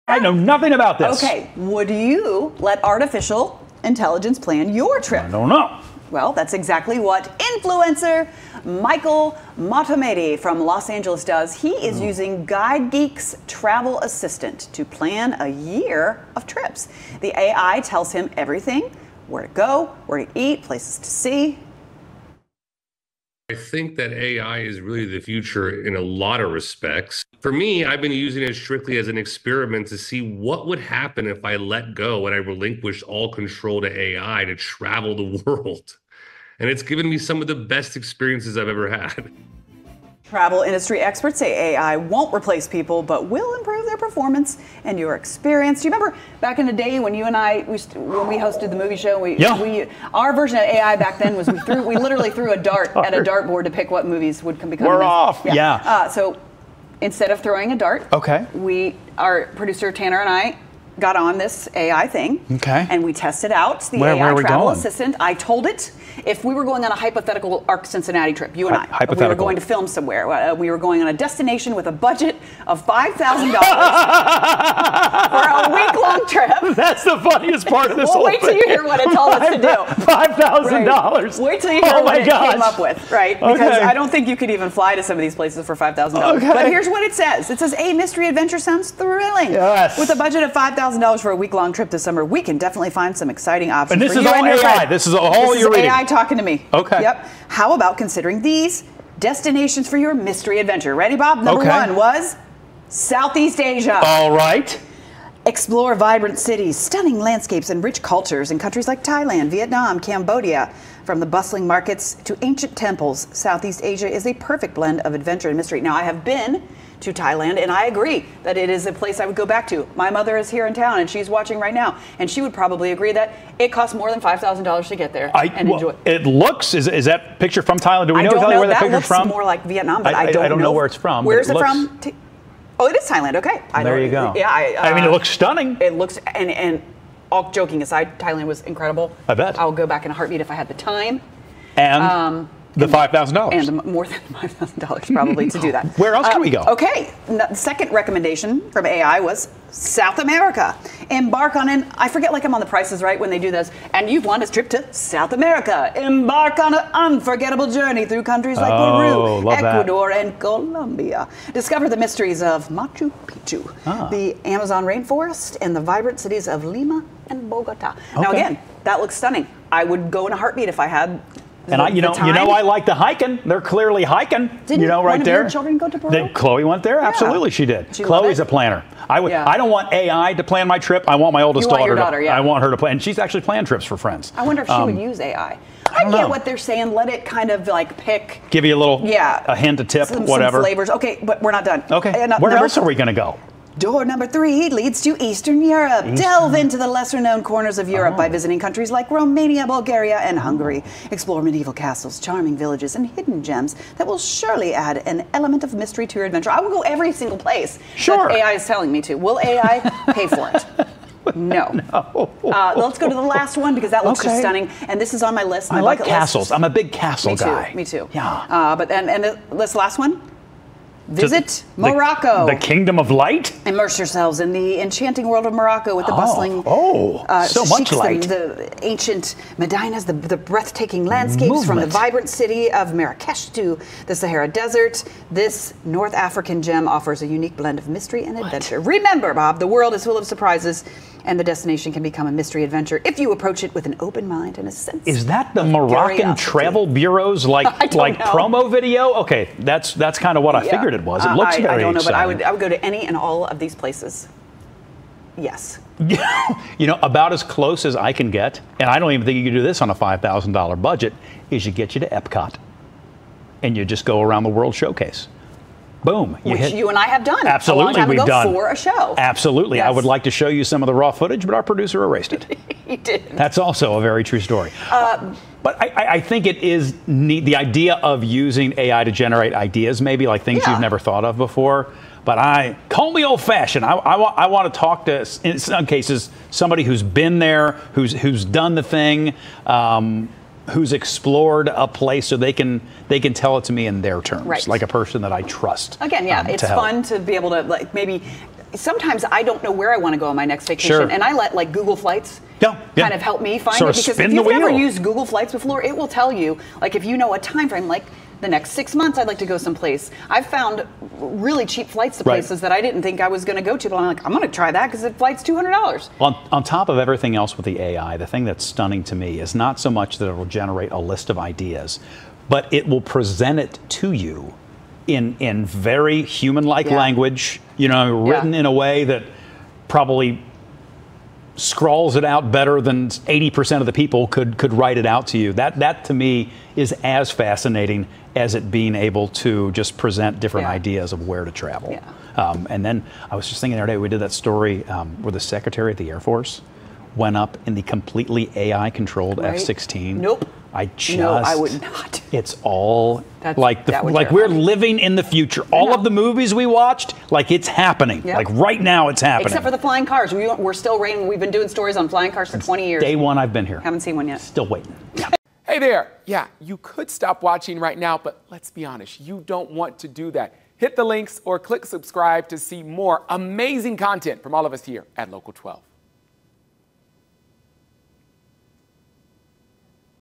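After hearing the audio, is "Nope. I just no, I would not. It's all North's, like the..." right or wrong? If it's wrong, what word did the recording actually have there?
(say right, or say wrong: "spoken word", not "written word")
wrong: "That", not "North".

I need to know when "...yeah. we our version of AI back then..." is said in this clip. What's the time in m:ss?
0:49.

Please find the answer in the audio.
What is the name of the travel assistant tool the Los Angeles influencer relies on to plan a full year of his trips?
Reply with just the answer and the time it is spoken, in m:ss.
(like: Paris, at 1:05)
GuideGeek, at 0:12.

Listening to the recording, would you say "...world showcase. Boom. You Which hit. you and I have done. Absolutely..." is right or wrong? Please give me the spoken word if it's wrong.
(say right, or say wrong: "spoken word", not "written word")
right.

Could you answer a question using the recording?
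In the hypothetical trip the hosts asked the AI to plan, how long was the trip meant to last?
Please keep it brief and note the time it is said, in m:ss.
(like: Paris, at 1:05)
A week, at 1:15.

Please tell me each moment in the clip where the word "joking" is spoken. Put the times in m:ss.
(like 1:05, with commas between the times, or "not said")
2:17.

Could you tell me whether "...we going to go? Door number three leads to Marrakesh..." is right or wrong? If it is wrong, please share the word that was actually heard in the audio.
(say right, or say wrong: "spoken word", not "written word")
wrong: "Eastern", not "Marrakesh".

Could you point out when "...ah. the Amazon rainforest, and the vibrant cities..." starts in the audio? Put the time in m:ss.
2:43.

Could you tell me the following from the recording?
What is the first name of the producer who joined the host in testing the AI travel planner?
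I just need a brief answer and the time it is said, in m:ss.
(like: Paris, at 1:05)
Tanner, at 0:59.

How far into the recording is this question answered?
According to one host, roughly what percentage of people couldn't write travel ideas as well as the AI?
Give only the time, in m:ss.
5:33.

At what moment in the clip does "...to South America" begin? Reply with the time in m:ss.
2:34.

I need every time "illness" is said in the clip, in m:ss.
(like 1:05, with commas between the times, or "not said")
not said.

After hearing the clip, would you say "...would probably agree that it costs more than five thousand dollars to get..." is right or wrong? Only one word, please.
right.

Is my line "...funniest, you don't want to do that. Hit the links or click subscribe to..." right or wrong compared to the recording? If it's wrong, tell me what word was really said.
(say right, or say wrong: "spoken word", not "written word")
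wrong: "honest", not "funniest".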